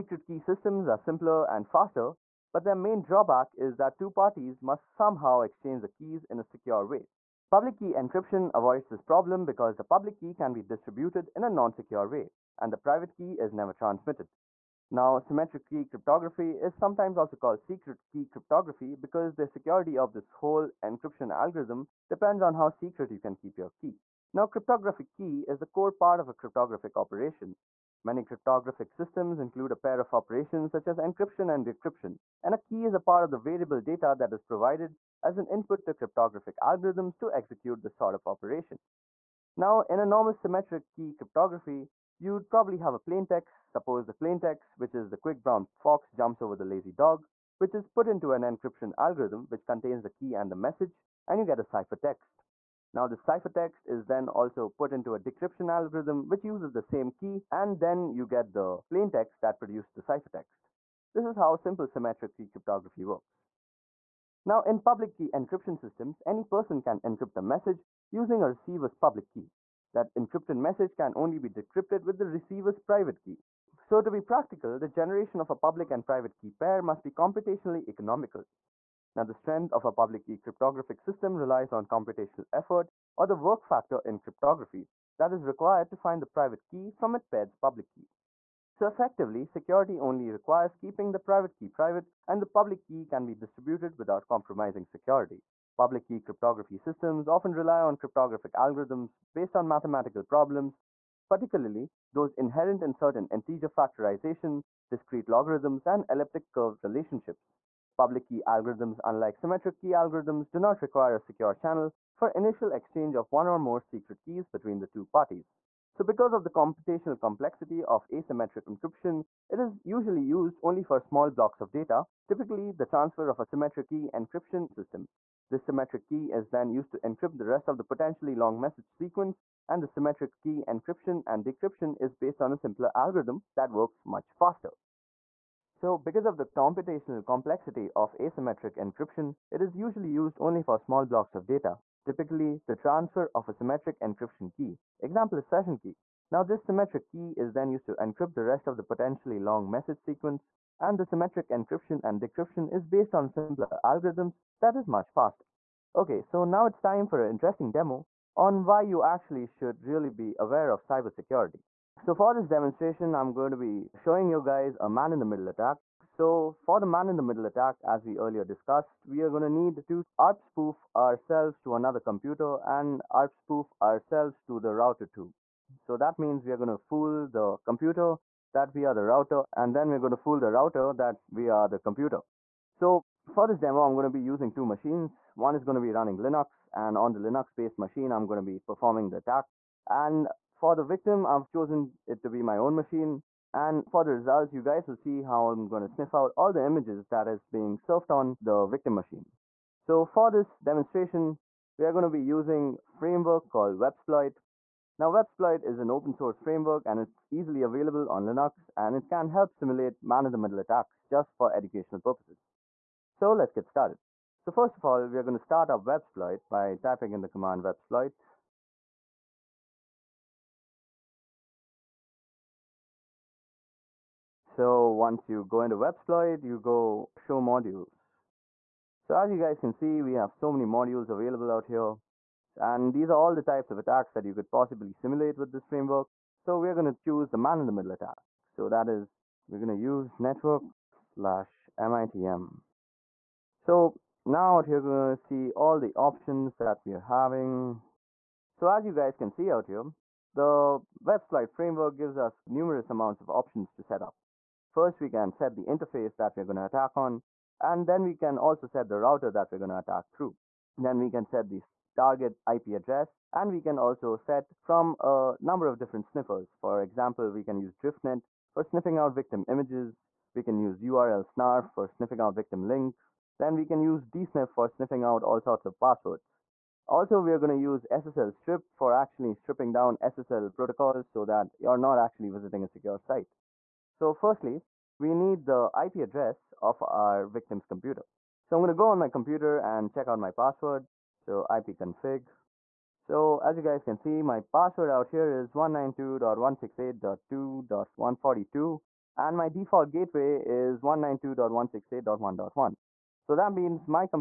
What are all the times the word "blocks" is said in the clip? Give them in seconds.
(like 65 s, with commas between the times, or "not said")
121 s, 141 s.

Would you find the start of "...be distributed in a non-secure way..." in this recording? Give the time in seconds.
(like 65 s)
10 s.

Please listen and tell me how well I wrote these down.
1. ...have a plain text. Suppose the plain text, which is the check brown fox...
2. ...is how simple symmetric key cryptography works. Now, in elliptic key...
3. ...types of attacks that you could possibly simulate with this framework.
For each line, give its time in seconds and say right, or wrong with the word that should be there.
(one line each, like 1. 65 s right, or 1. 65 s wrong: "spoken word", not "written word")
1. 42 s wrong: "quick", not "check"
2. 61 s wrong: "public", not "elliptic"
3. 233 s right.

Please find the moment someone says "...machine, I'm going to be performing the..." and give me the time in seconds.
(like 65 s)
187 s.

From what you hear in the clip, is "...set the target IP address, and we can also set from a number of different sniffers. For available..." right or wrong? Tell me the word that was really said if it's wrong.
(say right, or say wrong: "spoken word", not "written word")
wrong: "example", not "available".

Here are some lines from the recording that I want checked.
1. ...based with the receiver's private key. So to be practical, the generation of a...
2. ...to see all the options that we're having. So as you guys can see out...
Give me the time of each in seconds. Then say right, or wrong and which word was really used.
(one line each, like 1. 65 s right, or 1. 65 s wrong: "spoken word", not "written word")
1. 71 s wrong: "decrypted", not "based"
2. 245 s right.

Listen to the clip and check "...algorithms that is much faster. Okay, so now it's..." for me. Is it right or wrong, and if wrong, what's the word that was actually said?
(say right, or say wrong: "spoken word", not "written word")
right.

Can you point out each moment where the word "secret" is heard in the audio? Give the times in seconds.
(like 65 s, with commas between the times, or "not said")
17 s, 22 s, 113 s.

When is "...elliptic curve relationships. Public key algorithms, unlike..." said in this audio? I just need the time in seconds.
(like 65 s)
106 s.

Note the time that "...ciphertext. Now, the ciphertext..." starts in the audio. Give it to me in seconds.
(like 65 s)
51 s.